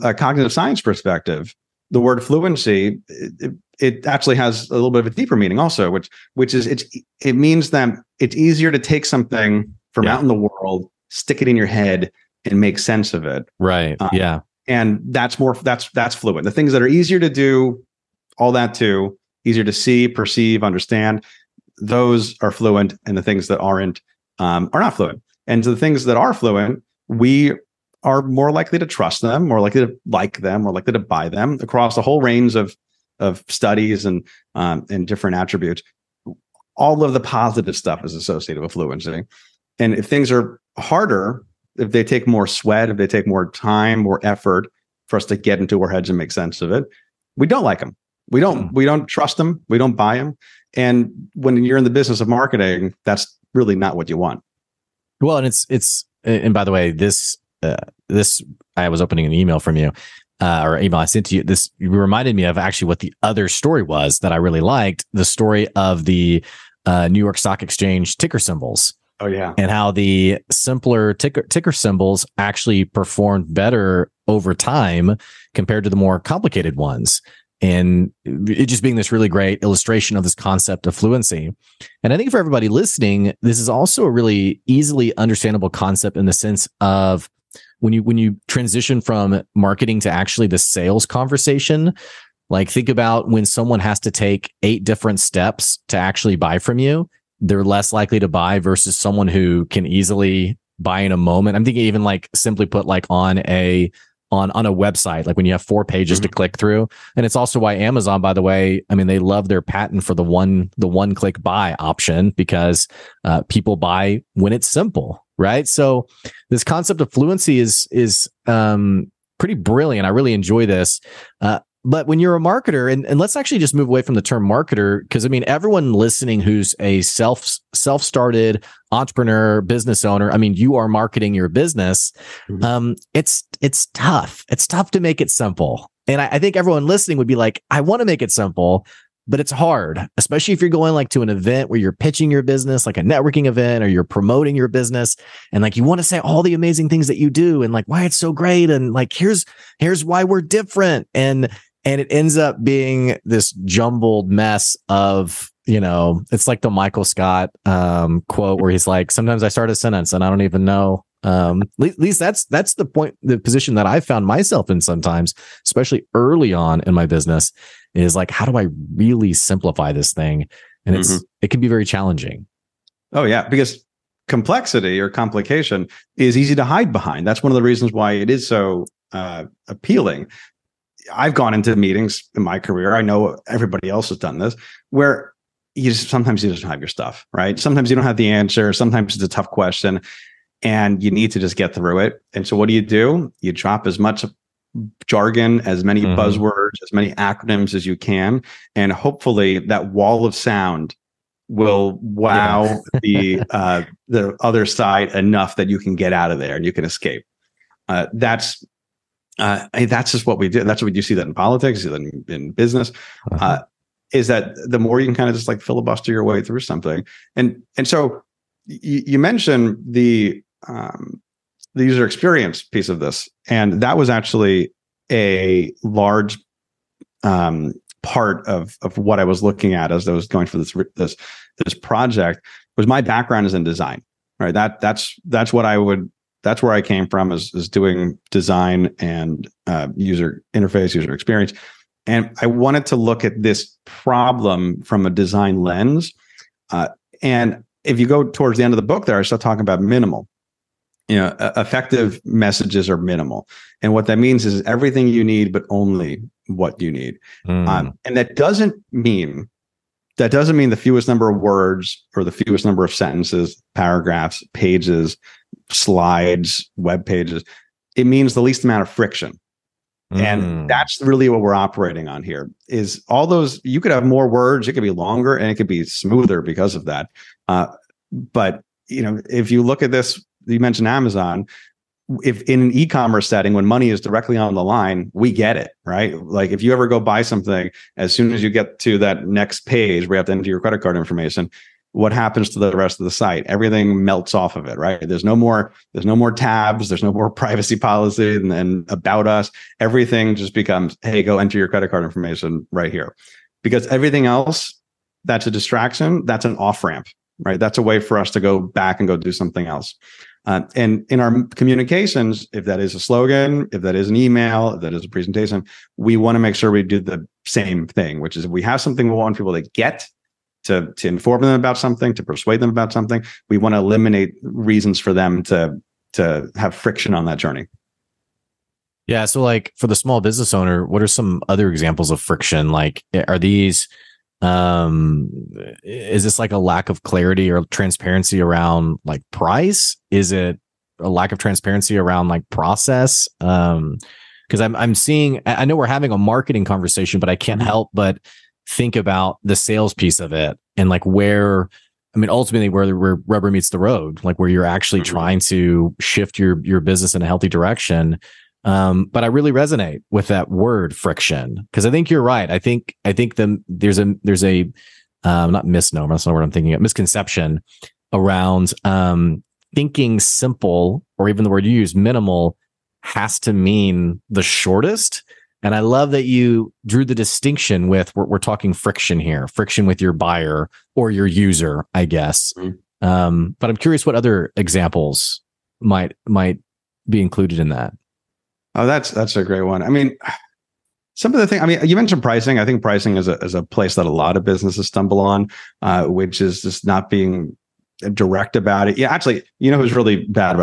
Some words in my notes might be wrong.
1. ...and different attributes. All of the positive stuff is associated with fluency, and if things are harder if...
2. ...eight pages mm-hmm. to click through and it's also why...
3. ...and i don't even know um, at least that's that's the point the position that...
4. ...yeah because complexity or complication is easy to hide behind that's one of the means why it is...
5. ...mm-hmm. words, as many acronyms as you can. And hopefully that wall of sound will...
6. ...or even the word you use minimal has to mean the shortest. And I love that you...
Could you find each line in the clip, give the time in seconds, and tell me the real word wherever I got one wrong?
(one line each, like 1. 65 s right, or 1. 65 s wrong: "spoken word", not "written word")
1. 34 s right
2. 105 s wrong: "four", not "eight"
3. 160 s right
4. 173 s wrong: "reasons", not "means"
5. 196 s wrong: "buzzwords", not "words"
6. 371 s right.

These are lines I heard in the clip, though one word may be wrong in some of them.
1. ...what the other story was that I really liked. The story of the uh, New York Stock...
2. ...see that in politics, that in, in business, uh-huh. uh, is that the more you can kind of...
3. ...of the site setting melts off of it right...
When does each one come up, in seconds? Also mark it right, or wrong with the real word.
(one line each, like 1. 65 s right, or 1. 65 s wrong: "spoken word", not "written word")
1. 62 s right
2. 211 s right
3. 292 s wrong: "everything", not "setting".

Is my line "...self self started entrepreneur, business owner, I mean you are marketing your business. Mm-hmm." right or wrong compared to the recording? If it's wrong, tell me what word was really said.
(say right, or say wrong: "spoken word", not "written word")
right.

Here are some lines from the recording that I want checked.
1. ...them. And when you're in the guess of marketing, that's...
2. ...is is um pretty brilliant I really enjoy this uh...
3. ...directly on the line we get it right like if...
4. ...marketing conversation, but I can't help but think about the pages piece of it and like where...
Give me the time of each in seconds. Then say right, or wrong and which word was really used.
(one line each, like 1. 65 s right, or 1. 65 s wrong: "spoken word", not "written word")
1. 50 s wrong: "business", not "guess"
2. 117 s right
3. 284 s right
4. 346 s wrong: "sales", not "pages".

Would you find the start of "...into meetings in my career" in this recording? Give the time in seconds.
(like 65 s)
181 s.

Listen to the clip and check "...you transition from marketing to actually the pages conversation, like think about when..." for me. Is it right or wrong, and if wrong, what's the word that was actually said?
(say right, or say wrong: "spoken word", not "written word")
wrong: "sales", not "pages".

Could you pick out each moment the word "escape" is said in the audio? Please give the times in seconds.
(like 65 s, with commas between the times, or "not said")
206 s.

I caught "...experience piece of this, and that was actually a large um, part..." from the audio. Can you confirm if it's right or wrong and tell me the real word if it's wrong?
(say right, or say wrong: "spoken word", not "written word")
right.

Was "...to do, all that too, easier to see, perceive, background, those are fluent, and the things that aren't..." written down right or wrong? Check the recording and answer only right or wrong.
wrong.